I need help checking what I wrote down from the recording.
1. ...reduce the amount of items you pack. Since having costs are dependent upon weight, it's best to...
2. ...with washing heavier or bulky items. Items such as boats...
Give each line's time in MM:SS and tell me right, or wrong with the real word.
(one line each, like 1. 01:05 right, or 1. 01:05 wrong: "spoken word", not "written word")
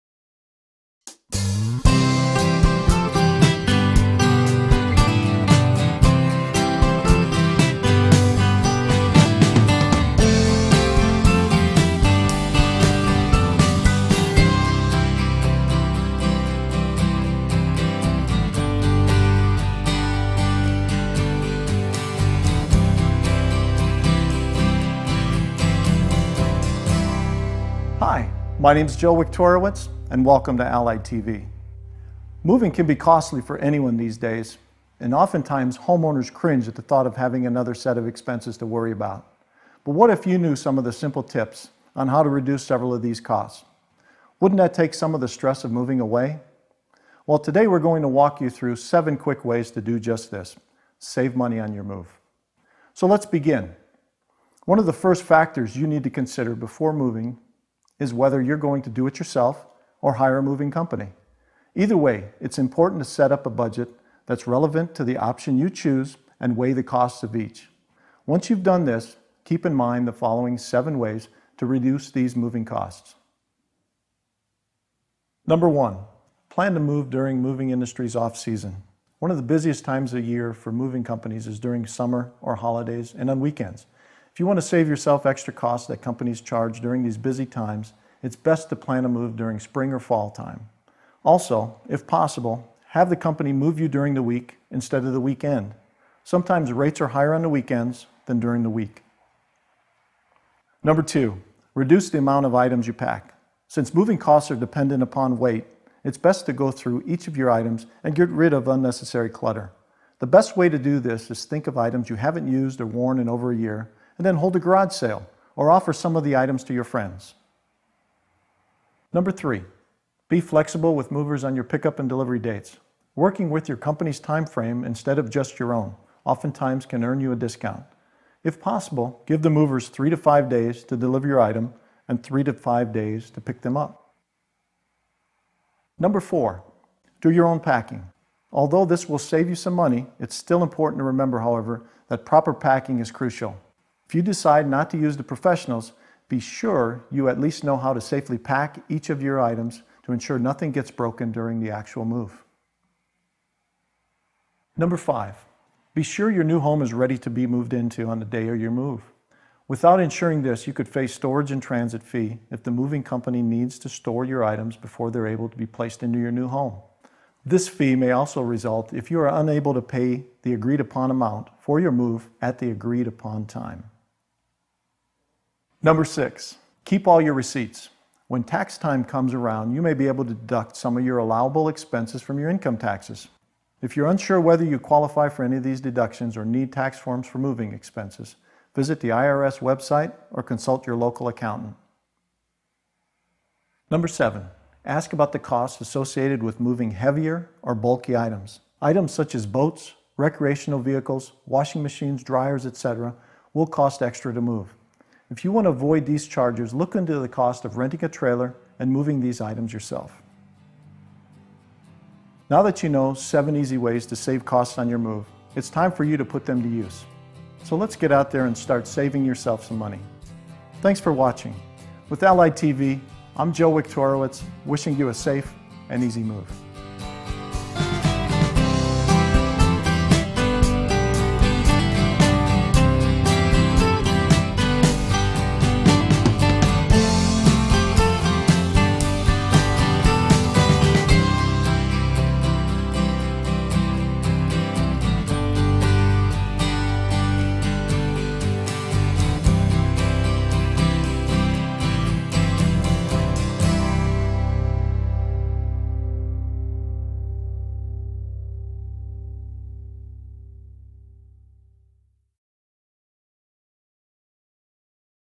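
1. 01:41 wrong: "moving", not "having"
2. 03:16 wrong: "moving", not "washing".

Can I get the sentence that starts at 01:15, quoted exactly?
Number one, plan to move during moving industry's off season.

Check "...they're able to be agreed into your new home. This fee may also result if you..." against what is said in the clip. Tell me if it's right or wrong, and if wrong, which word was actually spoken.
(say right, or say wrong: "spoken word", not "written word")
wrong: "placed", not "agreed".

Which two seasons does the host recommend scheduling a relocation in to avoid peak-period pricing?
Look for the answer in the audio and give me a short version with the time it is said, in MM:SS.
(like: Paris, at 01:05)
spring or fall, at 01:29.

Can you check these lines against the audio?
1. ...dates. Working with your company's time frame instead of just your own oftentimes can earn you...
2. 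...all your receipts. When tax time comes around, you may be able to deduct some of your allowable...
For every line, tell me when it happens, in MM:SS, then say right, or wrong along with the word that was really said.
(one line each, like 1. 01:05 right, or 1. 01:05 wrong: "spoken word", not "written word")
1. 02:02 right
2. 02:57 right.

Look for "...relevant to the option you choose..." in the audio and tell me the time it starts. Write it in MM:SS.
01:04.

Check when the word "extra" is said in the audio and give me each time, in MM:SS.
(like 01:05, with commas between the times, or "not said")
01:25, 03:24.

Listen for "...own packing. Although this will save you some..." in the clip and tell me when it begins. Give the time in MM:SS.
02:17.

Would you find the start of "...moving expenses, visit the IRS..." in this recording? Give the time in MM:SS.
03:07.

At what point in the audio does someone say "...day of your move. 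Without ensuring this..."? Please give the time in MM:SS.
02:38.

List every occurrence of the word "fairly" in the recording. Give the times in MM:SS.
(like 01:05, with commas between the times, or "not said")
not said.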